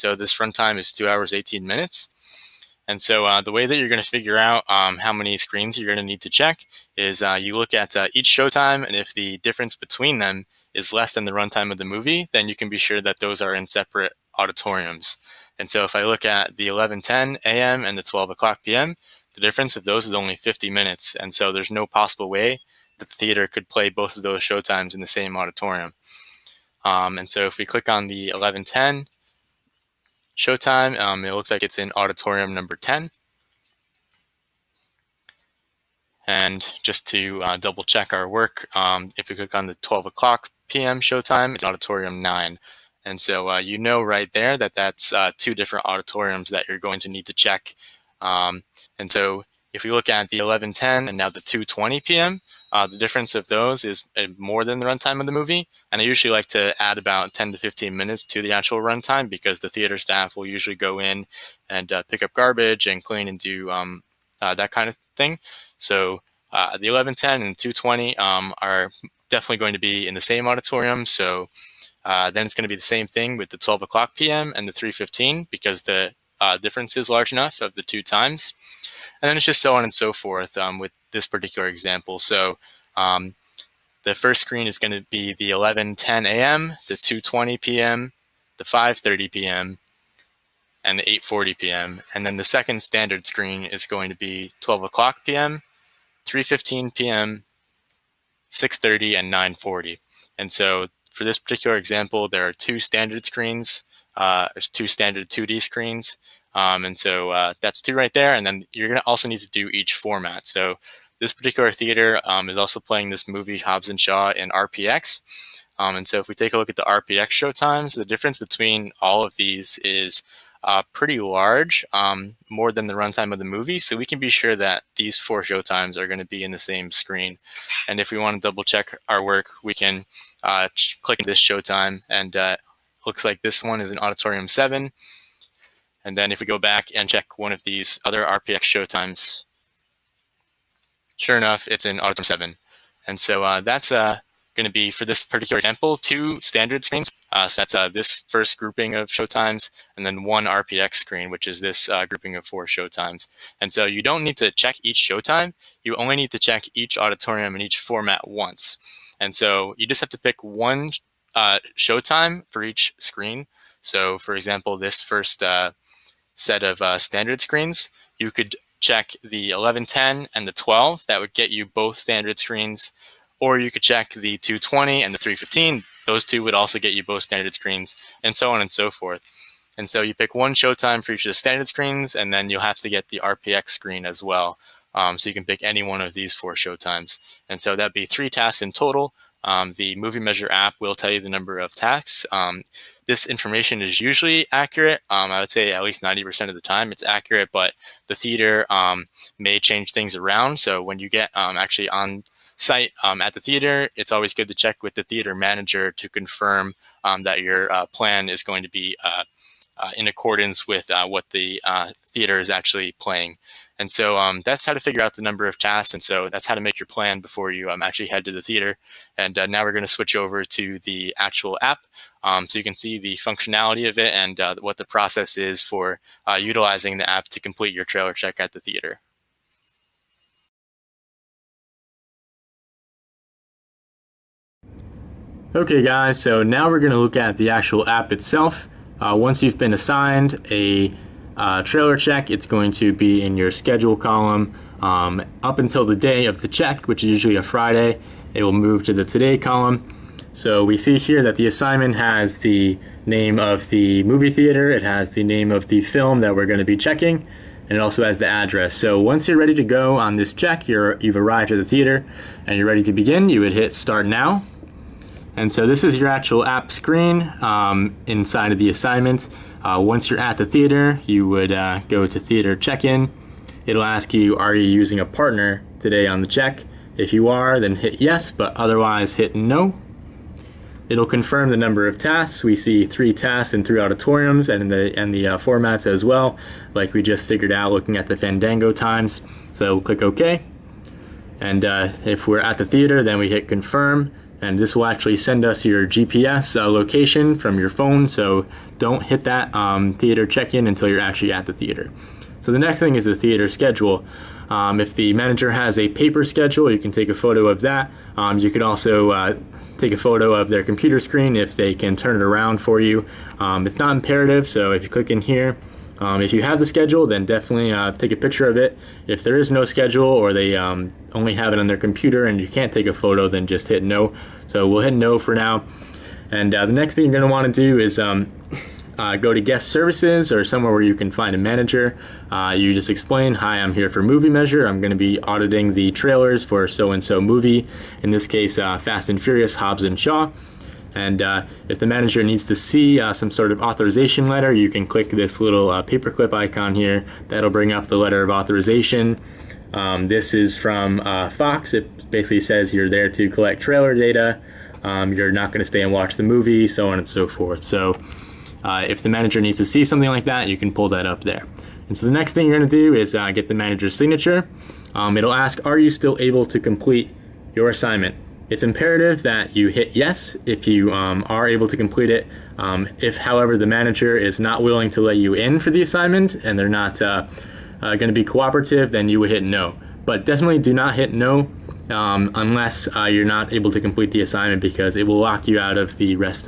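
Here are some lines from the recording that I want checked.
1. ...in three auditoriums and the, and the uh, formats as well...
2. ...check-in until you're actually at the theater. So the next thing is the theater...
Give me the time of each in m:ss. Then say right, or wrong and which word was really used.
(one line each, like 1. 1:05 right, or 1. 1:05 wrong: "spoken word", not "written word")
1. 4:43 right
2. 5:00 right.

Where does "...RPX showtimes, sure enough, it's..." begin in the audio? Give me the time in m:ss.
2:18.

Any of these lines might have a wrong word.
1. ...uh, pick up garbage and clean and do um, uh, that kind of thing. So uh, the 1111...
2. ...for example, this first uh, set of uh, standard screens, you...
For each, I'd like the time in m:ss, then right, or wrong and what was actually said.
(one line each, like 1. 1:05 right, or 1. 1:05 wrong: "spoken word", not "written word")
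1. 1:01 wrong: "1110", not "1111"
2. 2:44 right.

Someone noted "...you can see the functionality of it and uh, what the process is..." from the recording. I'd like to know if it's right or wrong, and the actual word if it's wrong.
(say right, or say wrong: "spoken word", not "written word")
right.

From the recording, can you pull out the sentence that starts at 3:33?
And so um, that's how to figure out the number of tasks.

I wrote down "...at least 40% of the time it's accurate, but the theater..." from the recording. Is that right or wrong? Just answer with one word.
wrong.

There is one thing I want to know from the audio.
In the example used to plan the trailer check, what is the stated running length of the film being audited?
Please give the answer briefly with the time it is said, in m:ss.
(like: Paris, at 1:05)
2 hours 18 minutes, at 0:00.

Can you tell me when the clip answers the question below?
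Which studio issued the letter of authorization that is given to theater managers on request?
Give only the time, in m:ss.
5:51.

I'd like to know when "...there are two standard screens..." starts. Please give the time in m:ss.
1:42.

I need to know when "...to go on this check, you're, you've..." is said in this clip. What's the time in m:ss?
4:19.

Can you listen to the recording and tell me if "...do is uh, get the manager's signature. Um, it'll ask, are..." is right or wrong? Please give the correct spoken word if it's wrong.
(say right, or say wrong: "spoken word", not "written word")
right.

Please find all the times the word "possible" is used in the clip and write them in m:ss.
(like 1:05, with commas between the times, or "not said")
0:21.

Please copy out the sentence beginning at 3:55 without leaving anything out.
Okay guys, so now we're going to look at the actual app itself.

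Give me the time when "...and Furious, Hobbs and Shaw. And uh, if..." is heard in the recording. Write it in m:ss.
5:39.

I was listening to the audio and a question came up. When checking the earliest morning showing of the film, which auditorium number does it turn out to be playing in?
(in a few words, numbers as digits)
10.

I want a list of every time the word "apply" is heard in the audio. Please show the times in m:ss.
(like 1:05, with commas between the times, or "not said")
not said.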